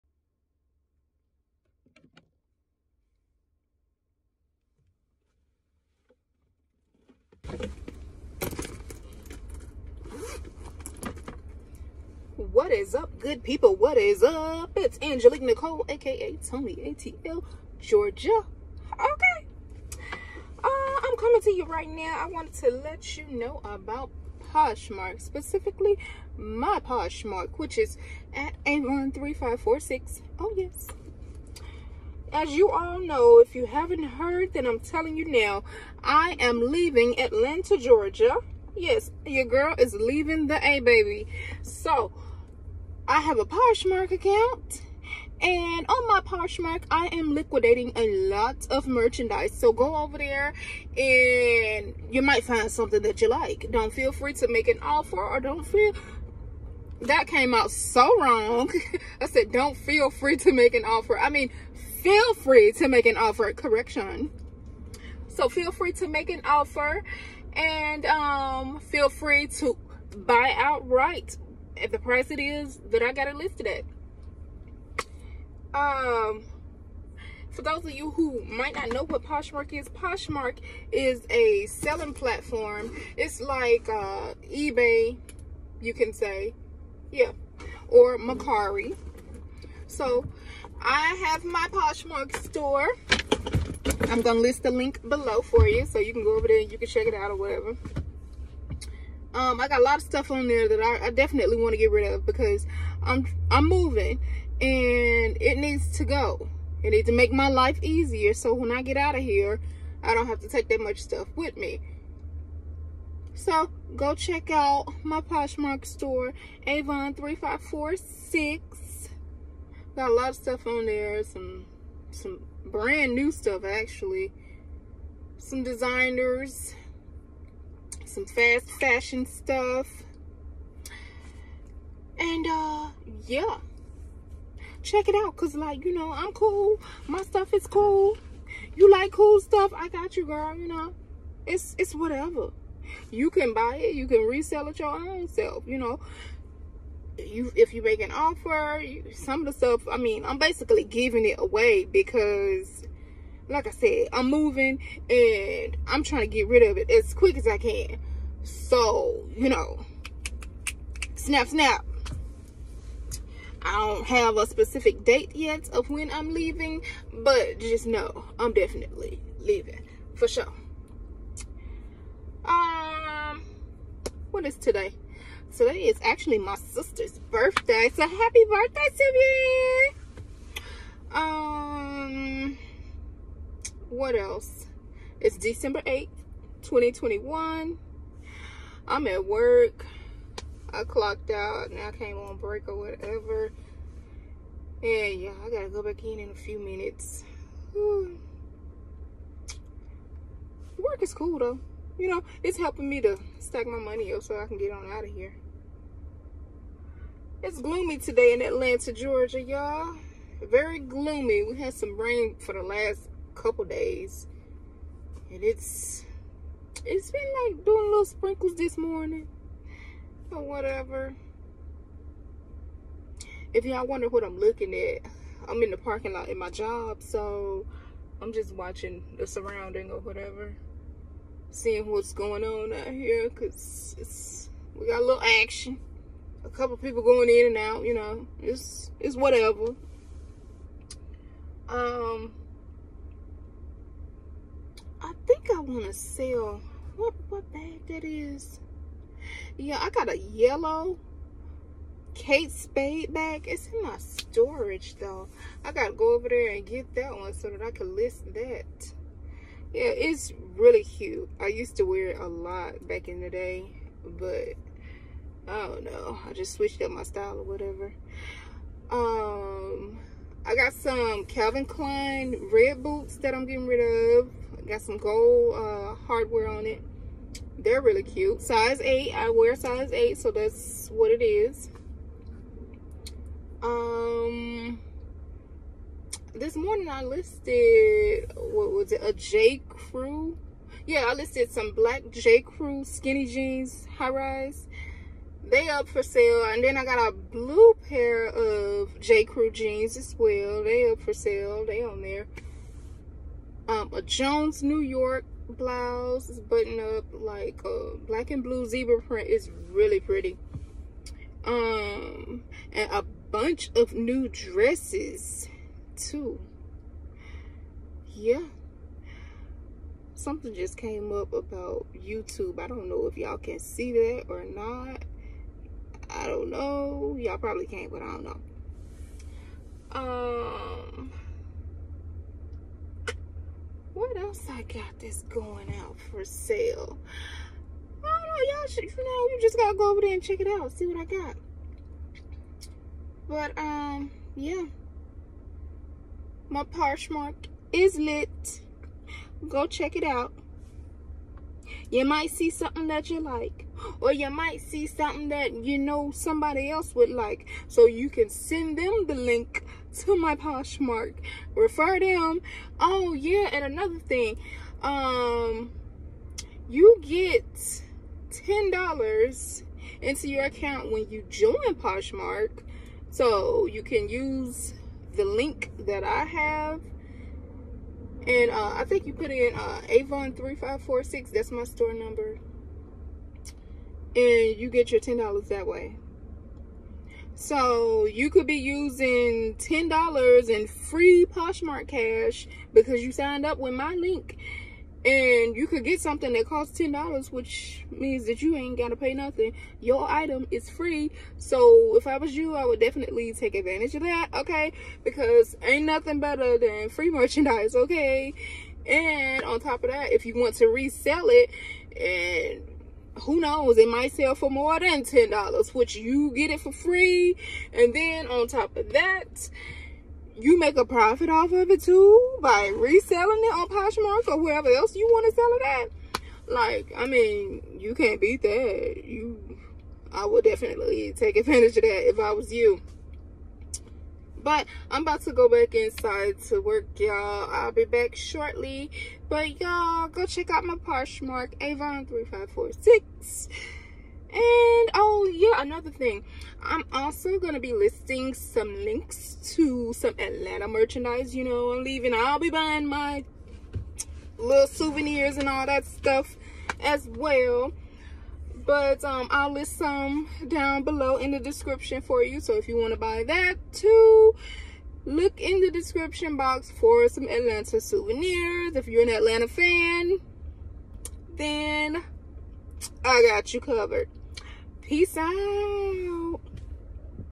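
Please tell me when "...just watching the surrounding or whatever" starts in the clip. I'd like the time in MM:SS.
03:48.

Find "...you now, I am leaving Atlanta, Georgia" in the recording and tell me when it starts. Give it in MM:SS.
00:35.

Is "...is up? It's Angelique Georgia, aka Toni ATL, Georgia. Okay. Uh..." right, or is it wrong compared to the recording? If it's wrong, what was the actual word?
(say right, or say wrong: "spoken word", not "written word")
wrong: "Nicole", not "Georgia".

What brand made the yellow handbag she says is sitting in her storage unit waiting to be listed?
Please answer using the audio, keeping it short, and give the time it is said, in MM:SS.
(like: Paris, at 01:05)
Kate Spade, at 04:12.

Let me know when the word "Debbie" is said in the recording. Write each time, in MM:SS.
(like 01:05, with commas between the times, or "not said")
not said.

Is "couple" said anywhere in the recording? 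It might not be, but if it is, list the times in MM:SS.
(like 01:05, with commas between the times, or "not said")
03:33, 03:56.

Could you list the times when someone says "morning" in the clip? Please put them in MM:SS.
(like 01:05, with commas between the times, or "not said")
03:38, 04:46.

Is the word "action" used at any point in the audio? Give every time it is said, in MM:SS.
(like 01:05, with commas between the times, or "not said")
03:55.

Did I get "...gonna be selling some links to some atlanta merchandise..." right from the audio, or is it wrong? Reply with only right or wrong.
wrong.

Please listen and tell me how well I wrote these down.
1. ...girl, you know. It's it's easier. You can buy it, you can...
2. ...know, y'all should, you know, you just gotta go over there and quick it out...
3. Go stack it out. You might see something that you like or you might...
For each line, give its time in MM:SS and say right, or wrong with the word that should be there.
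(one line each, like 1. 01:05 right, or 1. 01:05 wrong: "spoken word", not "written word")
1. 02:20 wrong: "whatever", not "easier"
2. 05:38 wrong: "check", not "quick"
3. 05:49 wrong: "check", not "stack".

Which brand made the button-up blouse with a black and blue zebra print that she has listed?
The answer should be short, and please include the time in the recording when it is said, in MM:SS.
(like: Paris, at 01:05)
Jones New York, at 05:04.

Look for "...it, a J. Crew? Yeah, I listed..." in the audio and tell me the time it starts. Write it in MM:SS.
04:48.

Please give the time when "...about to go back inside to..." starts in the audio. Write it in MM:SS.
07:15.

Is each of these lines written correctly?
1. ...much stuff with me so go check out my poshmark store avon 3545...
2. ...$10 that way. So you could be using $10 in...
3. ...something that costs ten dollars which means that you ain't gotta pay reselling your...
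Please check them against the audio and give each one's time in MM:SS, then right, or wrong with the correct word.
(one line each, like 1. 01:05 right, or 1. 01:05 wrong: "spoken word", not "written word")
1. 01:50 wrong: "3546", not "3545"
2. 06:25 right
3. 06:35 wrong: "nothing", not "reselling".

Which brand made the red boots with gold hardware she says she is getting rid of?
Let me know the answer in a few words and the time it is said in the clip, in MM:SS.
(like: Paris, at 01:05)
Calvin Klein, at 04:31.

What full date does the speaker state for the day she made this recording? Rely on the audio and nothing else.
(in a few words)
December 8th, 2021.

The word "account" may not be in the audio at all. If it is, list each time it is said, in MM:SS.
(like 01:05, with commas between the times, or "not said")
00:44, 06:10.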